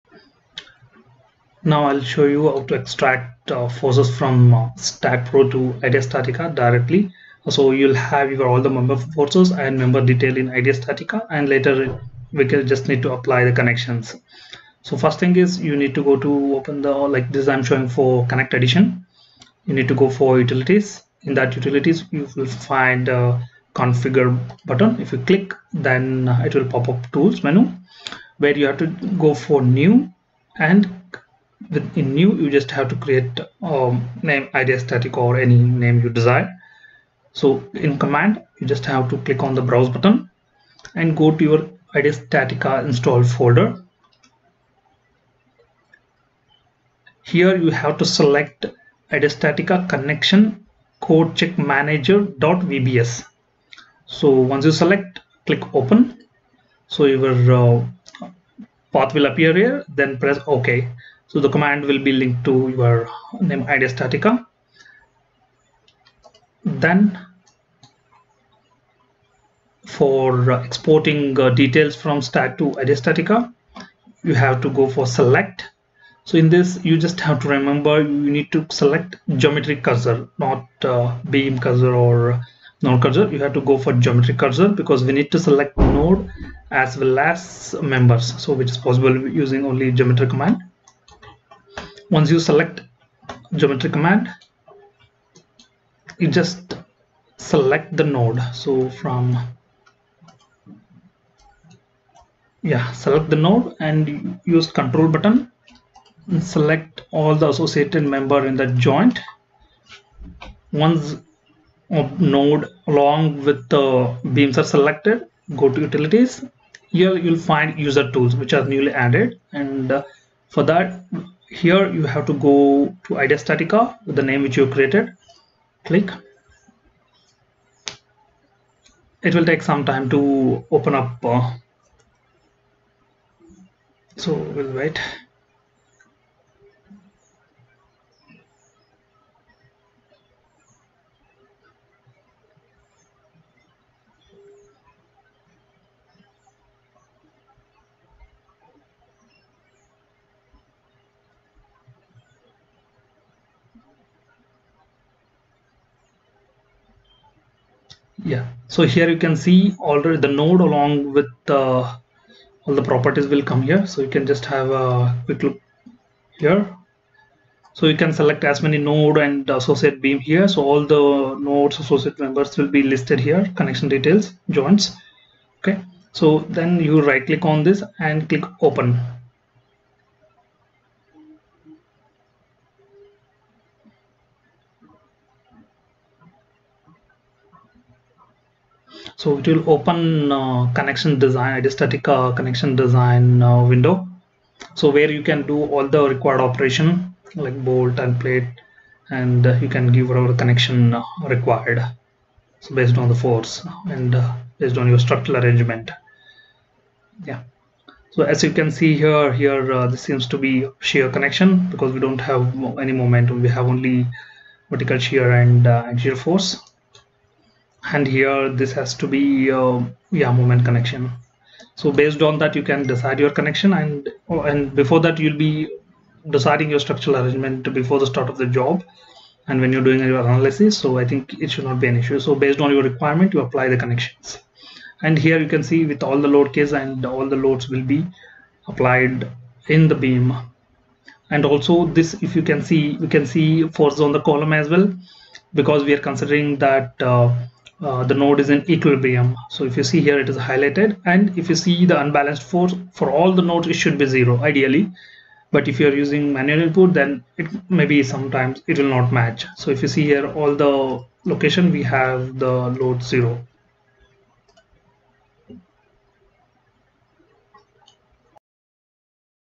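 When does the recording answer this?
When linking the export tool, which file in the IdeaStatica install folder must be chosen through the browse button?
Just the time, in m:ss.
0:49.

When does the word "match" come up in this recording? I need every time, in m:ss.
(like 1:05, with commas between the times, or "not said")
4:19.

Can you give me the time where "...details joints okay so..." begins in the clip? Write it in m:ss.
2:53.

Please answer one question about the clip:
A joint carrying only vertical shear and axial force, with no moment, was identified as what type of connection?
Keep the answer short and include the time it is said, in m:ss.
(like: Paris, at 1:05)
shear connection, at 3:30.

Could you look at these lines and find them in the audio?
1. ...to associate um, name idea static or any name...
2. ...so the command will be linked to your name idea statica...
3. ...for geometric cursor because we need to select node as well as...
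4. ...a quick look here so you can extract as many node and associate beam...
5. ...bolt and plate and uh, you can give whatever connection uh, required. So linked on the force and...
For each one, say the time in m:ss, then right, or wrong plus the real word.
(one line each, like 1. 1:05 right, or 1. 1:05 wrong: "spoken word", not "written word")
1. 0:32 wrong: "create", not "associate"
2. 1:01 right
3. 1:23 right
4. 2:44 wrong: "select", not "extract"
5. 3:17 wrong: "based", not "linked".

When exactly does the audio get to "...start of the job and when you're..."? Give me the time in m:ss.
3:48.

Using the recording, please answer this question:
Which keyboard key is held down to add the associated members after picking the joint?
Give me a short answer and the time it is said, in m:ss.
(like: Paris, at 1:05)
control, at 1:44.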